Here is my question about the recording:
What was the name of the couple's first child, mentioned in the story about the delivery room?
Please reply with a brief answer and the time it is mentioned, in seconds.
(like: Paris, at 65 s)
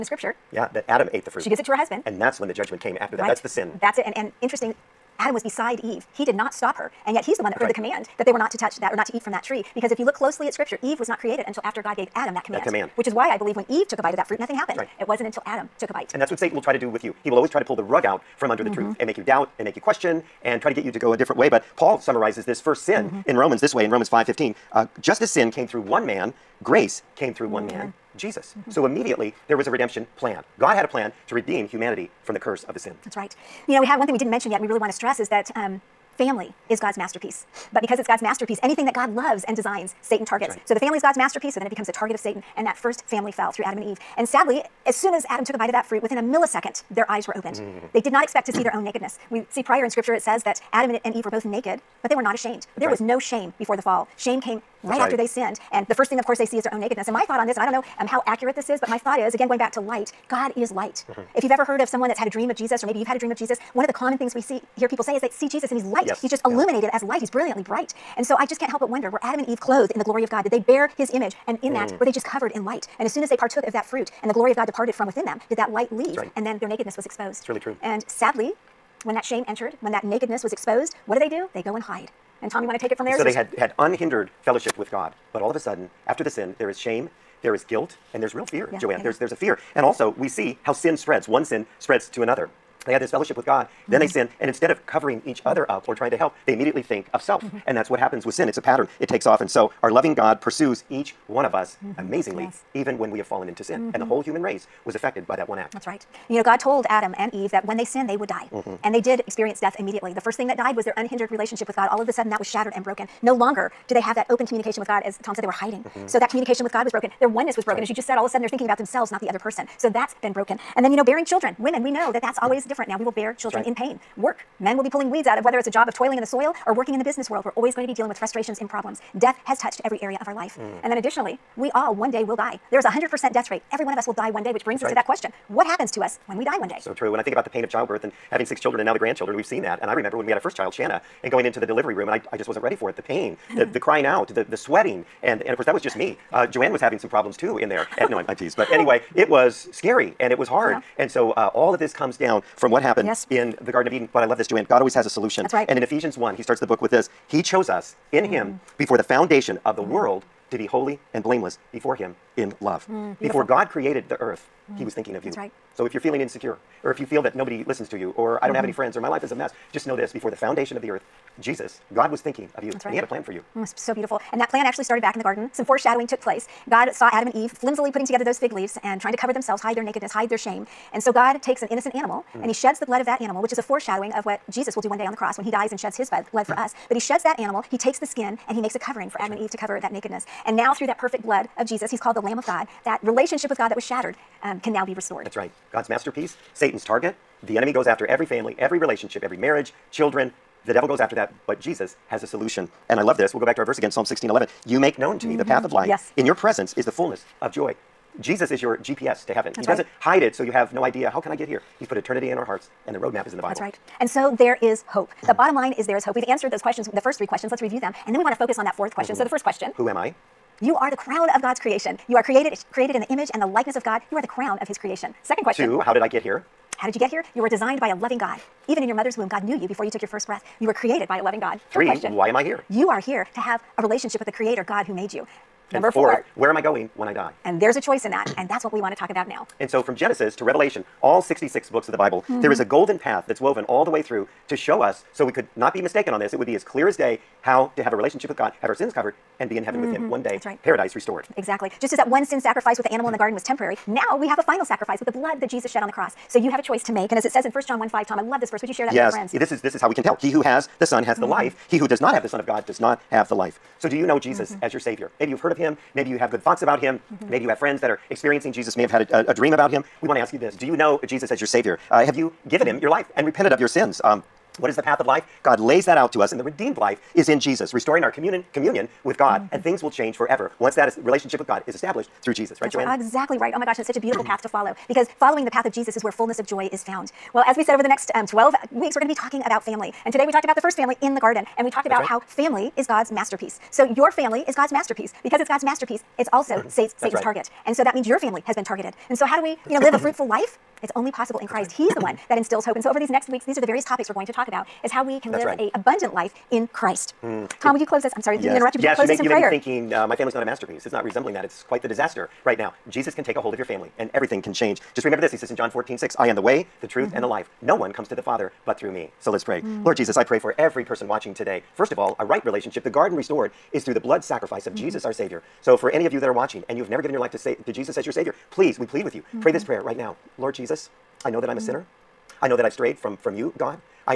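Shanna, at 140 s.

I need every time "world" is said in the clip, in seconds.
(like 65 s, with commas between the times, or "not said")
127 s, 159 s.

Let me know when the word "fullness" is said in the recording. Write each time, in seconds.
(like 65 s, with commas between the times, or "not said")
206 s, 286 s.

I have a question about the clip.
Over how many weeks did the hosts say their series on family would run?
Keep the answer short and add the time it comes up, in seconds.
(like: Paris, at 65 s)
12, at 288 s.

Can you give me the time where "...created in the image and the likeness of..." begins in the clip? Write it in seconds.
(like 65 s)
222 s.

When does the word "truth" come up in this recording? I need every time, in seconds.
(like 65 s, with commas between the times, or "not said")
18 s, 316 s.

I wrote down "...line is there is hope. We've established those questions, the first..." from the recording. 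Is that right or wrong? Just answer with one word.
wrong.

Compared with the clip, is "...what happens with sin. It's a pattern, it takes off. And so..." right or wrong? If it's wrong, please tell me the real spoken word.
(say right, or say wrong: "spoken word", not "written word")
right.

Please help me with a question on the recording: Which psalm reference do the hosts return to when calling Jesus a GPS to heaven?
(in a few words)
Psalm 16:11.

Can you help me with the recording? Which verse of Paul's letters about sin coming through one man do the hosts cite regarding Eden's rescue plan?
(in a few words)
Romans 5:15.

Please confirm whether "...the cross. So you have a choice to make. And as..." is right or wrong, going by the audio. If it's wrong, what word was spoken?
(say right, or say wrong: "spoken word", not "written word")
right.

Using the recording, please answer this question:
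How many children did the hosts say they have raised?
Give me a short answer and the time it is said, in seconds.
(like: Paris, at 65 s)
6, at 138 s.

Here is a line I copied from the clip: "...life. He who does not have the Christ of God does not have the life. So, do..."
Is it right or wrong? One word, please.
wrong.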